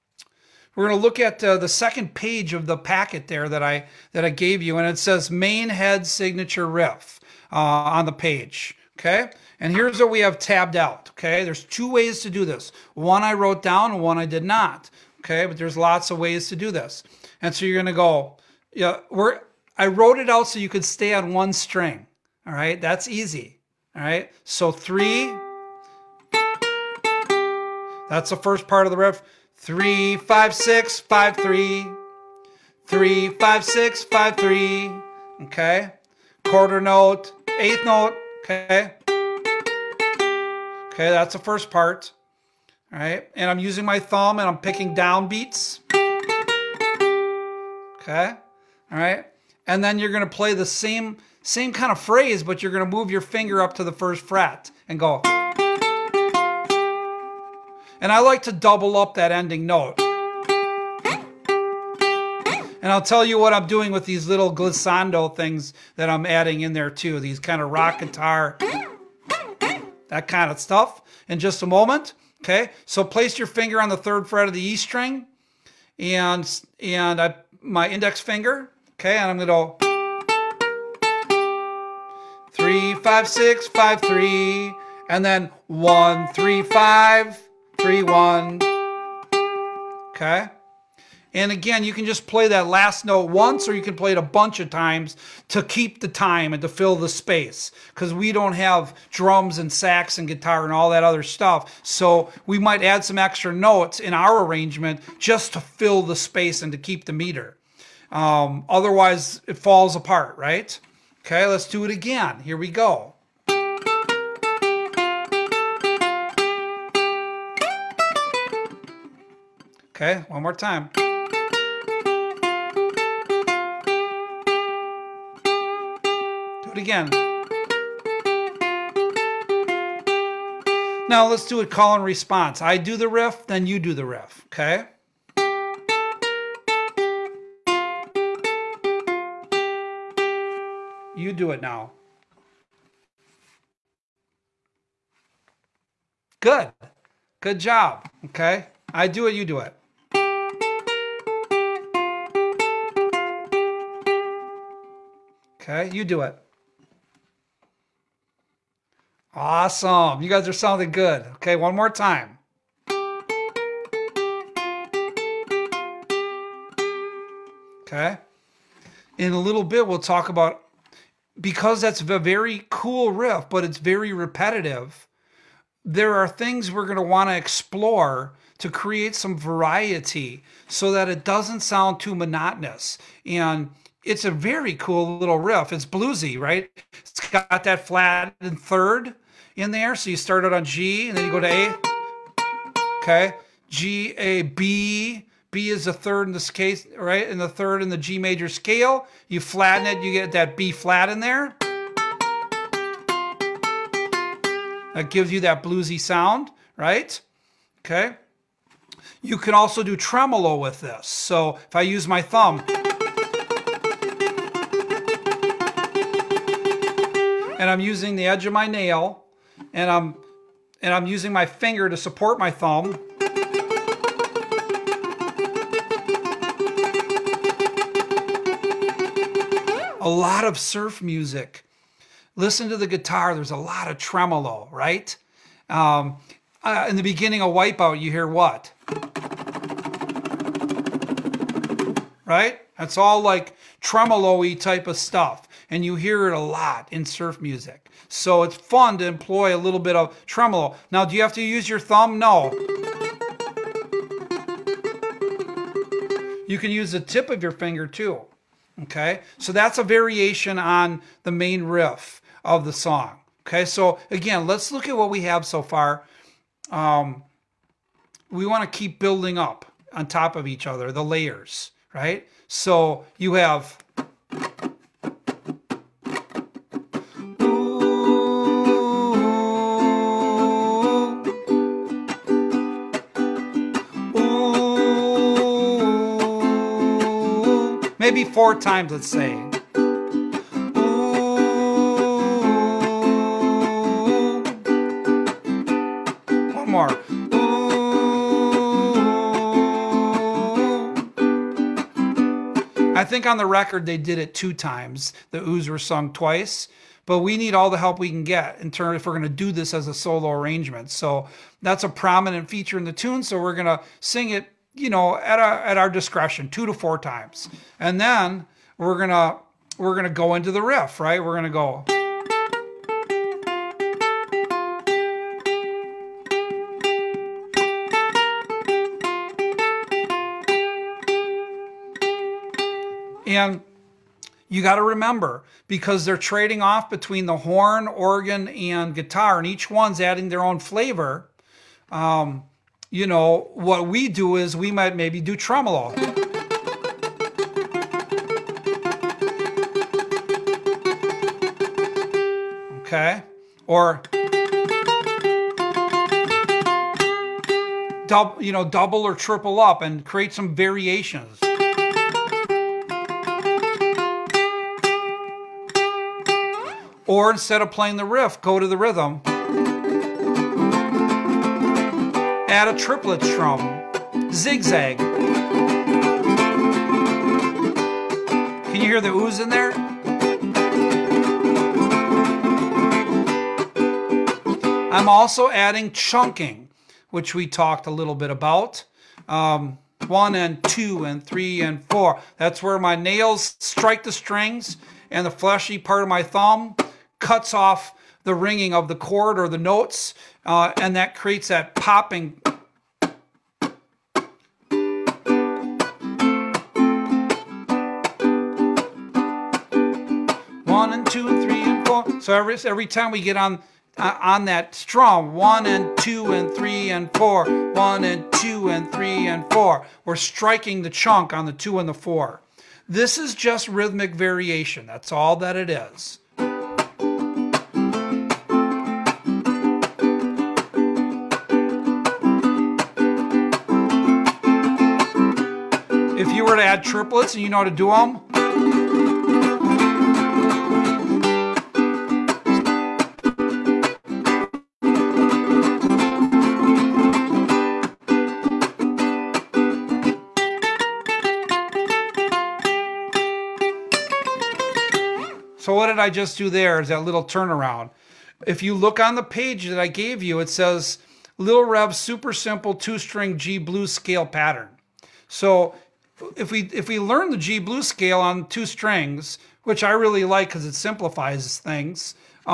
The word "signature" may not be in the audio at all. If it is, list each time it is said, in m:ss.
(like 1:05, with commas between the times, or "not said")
0:06.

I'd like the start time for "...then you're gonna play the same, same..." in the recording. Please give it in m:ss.
0:49.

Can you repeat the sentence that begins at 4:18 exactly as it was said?
Okay, so that's a variation on the main riff of the song.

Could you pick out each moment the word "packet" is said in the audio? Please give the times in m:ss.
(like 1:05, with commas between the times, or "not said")
0:02.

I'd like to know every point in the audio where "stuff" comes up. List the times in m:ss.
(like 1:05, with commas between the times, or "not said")
1:10, 1:41, 4:04.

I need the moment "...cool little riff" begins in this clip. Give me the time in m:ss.
3:04.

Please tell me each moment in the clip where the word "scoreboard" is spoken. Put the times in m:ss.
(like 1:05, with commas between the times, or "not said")
not said.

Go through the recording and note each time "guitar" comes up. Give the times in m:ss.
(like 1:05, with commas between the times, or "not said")
1:07, 1:40, 3:52, 5:38.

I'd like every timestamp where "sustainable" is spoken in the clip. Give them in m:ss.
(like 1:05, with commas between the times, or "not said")
not said.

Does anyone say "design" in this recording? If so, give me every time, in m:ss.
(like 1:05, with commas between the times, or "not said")
not said.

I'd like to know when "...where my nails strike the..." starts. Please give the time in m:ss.
6:32.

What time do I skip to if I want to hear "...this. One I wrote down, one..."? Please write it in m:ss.
0:12.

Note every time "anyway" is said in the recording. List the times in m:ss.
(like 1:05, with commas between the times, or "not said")
not said.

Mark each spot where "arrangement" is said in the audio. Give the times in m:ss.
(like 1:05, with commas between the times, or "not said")
1:44, 5:10.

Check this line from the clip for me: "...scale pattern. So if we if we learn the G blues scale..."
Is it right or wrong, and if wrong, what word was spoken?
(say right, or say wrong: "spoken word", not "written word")
right.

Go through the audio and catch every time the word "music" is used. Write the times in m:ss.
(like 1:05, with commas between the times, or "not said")
3:51, 4:07.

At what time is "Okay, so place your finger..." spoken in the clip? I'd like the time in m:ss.
1:12.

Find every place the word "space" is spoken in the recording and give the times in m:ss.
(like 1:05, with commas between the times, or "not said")
1:37, 1:46.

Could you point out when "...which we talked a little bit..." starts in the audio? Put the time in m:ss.
6:27.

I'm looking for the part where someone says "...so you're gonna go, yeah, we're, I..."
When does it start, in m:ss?
0:17.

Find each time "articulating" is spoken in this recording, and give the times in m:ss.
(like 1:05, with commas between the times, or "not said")
not said.